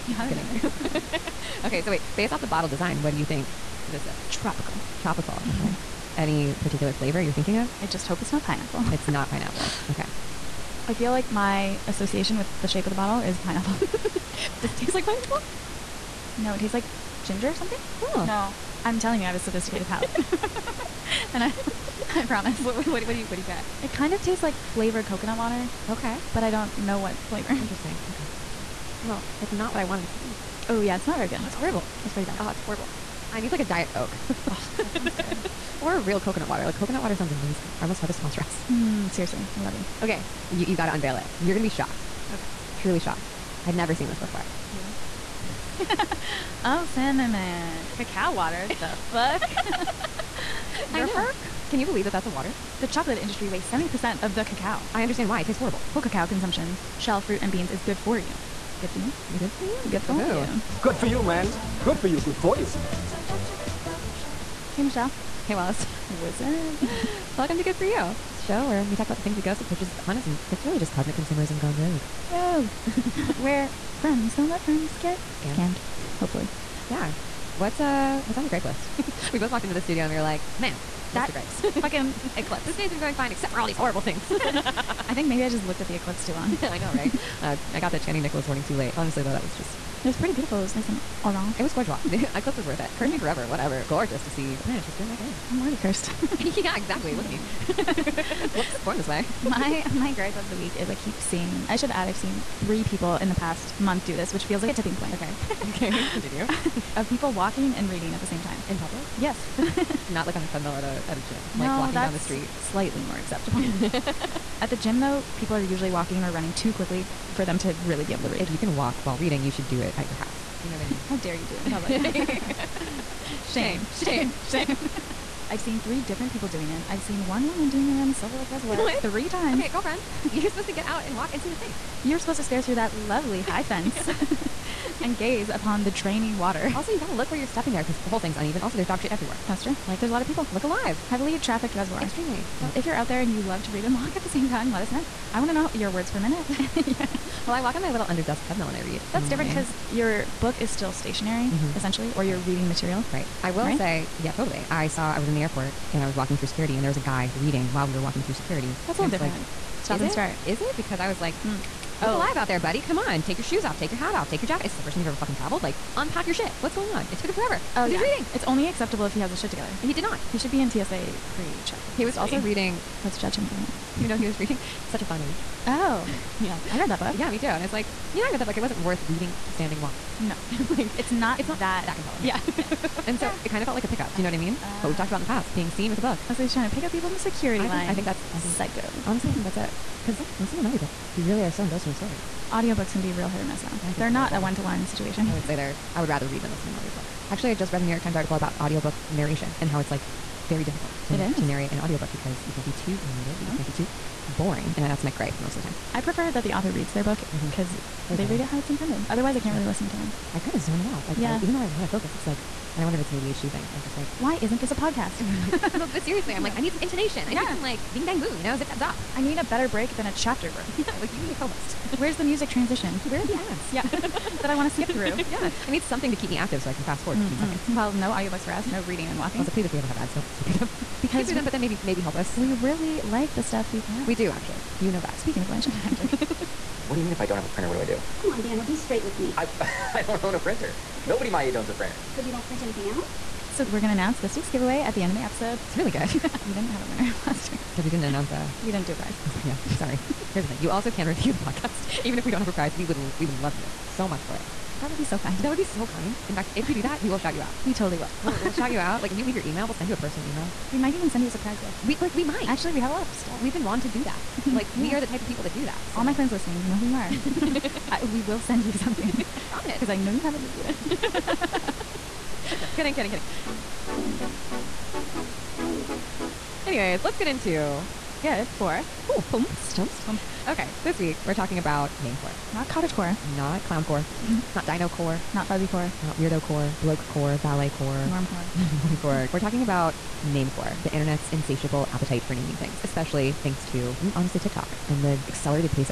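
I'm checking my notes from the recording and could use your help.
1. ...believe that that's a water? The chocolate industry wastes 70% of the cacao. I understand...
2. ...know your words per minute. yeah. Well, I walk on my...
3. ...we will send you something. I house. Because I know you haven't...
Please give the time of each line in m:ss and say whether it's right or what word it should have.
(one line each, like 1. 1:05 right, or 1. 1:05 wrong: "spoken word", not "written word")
1. 0:51 right
2. 2:25 right
3. 4:28 wrong: "promise", not "house".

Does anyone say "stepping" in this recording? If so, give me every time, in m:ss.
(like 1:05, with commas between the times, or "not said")
2:17.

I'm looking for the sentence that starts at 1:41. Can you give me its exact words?
I should add I've seen three people in the past month do this, which feels like a tipping point.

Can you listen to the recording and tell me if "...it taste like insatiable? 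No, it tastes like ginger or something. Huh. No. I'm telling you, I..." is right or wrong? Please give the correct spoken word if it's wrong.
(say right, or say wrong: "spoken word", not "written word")
wrong: "pineapple", not "insatiable".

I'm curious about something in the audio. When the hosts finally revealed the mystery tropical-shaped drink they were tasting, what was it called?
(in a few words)
cinnamon cacao water.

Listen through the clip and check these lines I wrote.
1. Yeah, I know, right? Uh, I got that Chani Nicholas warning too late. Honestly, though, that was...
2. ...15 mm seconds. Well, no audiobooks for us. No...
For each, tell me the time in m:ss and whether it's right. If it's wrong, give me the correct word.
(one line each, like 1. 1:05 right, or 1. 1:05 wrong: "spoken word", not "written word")
1. 1:26 right
2. 3:47 right.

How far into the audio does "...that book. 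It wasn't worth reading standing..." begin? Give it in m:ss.
2:58.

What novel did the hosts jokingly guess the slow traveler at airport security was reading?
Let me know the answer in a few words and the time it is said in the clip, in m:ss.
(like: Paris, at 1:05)
Such a Fun Age, at 2:54.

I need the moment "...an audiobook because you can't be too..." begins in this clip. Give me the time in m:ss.
3:21.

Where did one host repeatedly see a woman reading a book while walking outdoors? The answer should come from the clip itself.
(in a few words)
Silver Lake Reservoir.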